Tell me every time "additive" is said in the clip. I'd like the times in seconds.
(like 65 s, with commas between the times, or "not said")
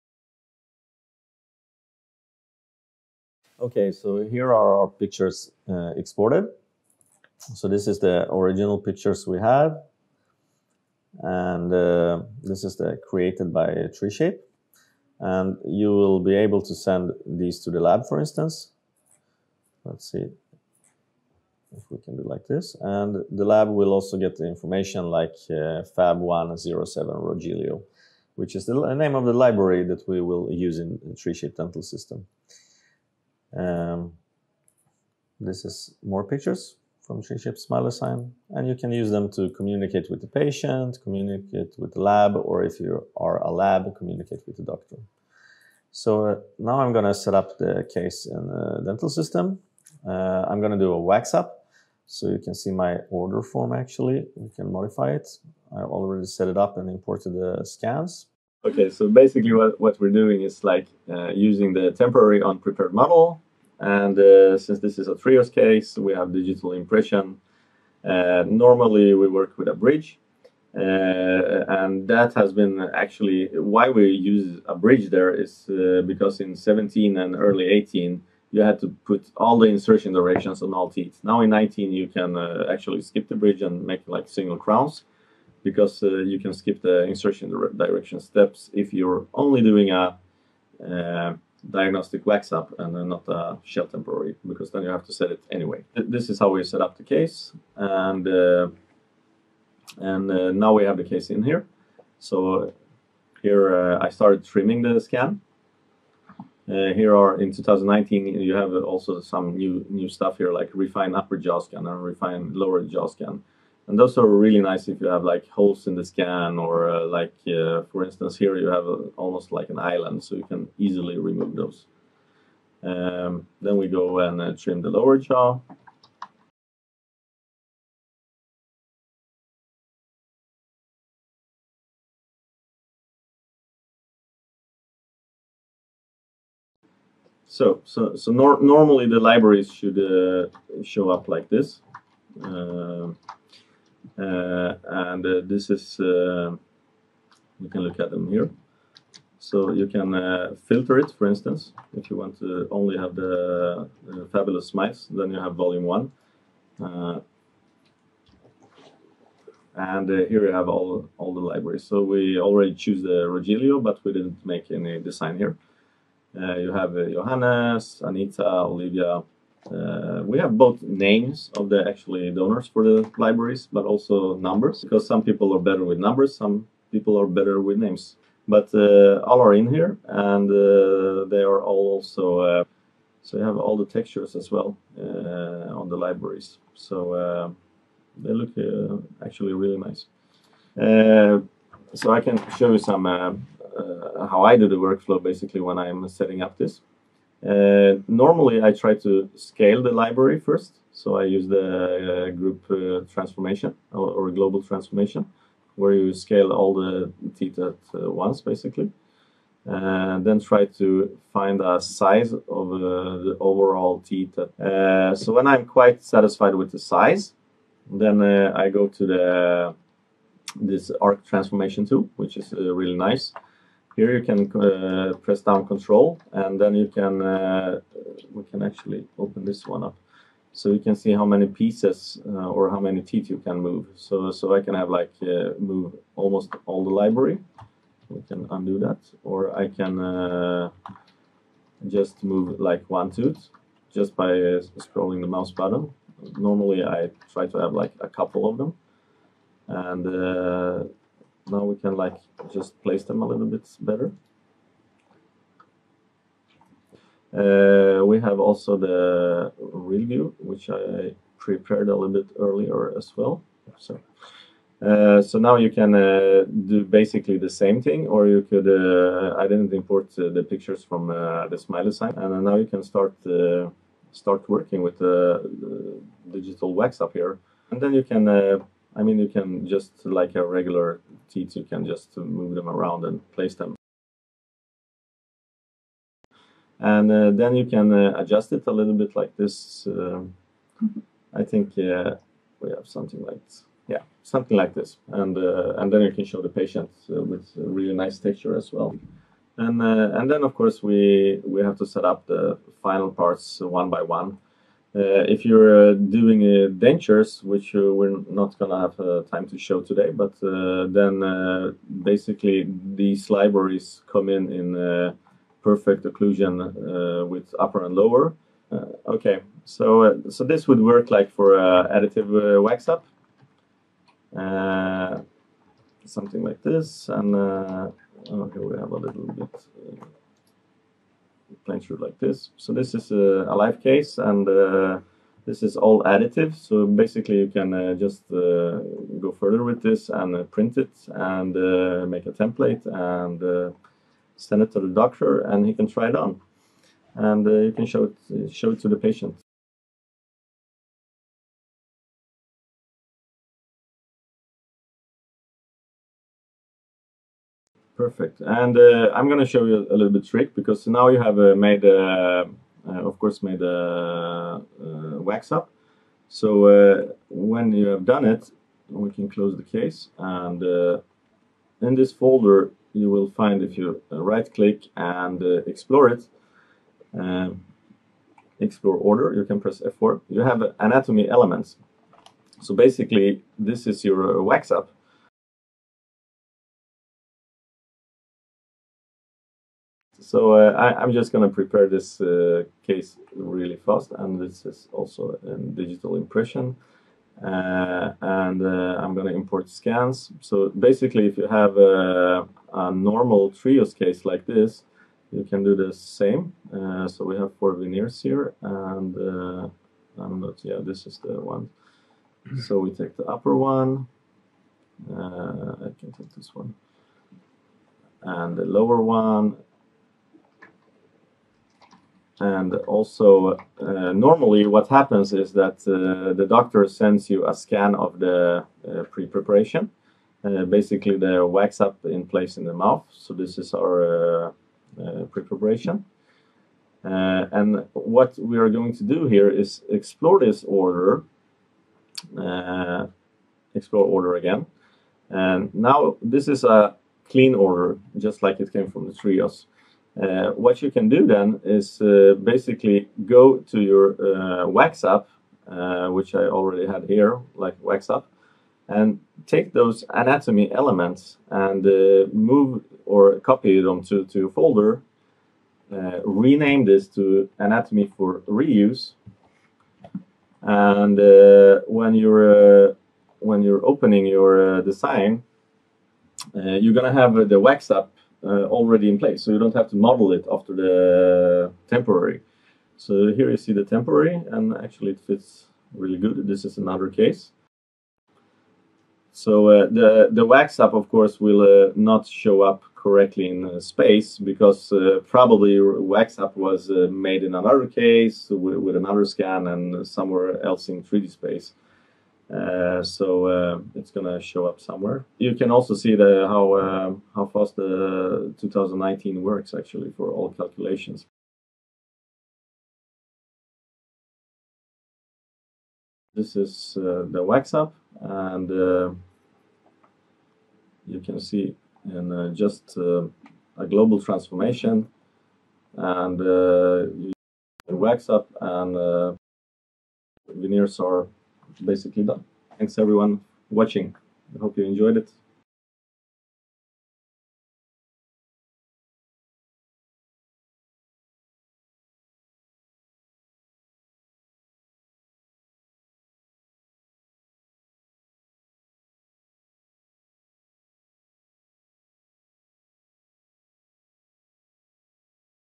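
321 s, 336 s.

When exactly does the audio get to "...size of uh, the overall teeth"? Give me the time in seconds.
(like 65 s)
211 s.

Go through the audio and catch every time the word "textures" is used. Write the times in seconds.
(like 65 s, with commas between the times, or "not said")
183 s, 298 s.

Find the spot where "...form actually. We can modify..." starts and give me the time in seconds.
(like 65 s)
53 s.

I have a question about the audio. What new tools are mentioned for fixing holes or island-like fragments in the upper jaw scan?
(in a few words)
Refine upper jaw scan.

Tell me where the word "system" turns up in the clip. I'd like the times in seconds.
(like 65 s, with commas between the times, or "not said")
31 s, 49 s.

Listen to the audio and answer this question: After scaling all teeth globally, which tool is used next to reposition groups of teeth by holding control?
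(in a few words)
Arc transformation tool.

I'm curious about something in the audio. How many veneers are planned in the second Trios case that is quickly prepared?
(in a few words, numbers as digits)
4.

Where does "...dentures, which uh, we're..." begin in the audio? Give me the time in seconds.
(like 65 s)
306 s.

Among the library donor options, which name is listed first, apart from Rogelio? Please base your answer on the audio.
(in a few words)
Johannes.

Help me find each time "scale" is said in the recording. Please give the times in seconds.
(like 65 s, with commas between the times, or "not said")
199 s, 206 s.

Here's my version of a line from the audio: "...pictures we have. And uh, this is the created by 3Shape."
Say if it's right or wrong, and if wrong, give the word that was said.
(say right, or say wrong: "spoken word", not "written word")
right.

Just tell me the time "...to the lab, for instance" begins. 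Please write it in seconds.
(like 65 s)
17 s.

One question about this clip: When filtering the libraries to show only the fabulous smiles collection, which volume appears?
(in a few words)
Volume one.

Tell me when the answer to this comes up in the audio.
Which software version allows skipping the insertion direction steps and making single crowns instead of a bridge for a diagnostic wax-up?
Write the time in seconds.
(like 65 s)
81 s.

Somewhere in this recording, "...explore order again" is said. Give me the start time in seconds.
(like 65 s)
443 s.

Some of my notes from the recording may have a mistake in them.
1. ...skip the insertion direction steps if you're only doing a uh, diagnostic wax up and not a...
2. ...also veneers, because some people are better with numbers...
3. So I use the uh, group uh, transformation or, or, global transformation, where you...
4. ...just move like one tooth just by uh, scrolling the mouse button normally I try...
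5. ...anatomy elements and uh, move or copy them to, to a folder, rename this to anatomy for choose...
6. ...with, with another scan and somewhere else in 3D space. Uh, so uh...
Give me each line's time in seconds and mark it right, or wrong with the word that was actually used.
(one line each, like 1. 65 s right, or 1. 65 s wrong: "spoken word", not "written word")
1. 86 s right
2. 173 s wrong: "numbers", not "veneers"
3. 200 s right
4. 241 s right
5. 460 s wrong: "reuse", not "choose"
6. 498 s right.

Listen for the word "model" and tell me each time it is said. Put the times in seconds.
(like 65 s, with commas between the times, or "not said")
62 s, 479 s.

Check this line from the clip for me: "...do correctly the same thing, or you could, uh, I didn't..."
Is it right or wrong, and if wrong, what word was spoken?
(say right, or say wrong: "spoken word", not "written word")
wrong: "basically", not "correctly".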